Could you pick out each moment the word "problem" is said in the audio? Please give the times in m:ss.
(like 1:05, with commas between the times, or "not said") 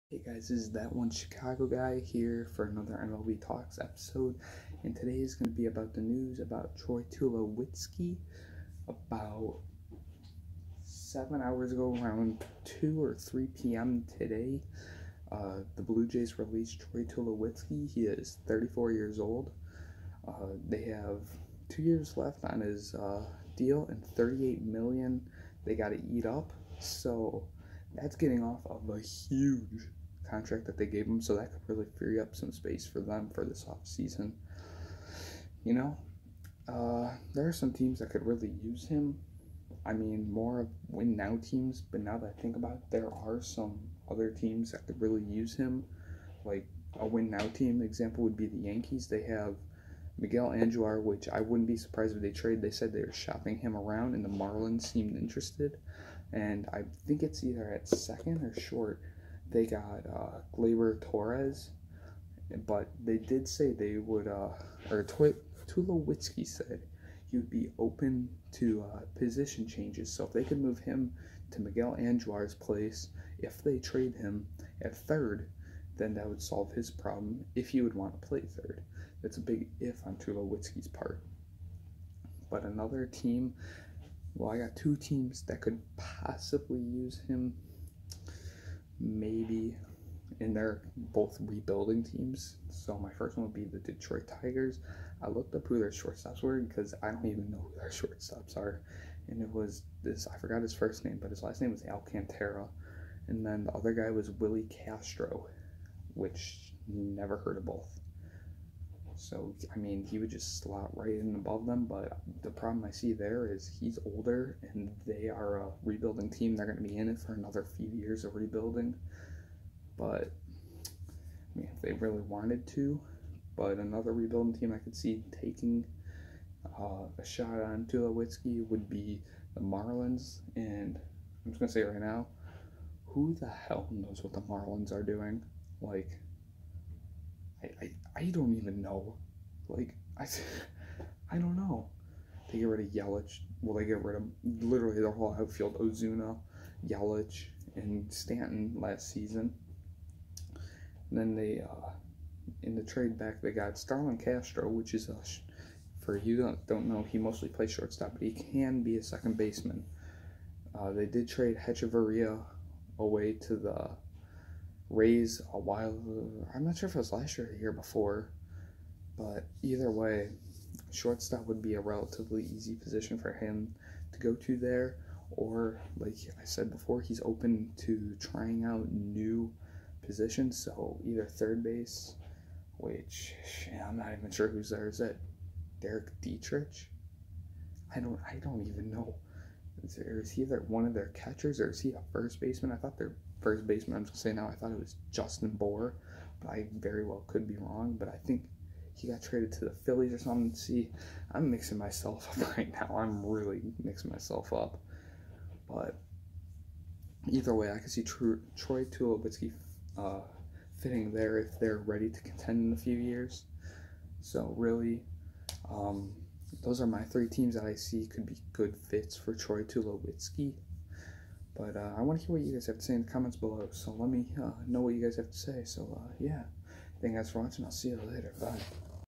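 1:16, 1:52.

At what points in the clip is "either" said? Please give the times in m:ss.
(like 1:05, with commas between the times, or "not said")
0:57, 2:49, 3:01, 3:10, 3:27.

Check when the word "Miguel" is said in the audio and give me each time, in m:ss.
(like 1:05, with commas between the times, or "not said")
0:50, 1:11.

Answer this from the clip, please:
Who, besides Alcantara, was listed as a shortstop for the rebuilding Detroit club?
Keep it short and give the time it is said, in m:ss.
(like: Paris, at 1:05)
Willi Castro, at 1:44.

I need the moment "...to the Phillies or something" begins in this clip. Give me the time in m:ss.
3:19.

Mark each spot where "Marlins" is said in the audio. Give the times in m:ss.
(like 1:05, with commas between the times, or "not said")
0:54, 2:09, 2:14.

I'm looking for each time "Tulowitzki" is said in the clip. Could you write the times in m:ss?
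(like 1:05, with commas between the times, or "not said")
0:07, 0:17, 1:05, 1:20, 2:07, 3:28, 3:39.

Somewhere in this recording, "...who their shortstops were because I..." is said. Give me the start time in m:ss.
1:35.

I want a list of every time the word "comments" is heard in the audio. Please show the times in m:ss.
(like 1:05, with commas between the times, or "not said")
3:43.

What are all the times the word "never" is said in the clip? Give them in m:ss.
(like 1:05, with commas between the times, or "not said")
1:46.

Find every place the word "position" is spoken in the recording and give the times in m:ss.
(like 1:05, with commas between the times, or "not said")
1:09, 2:52, 3:00.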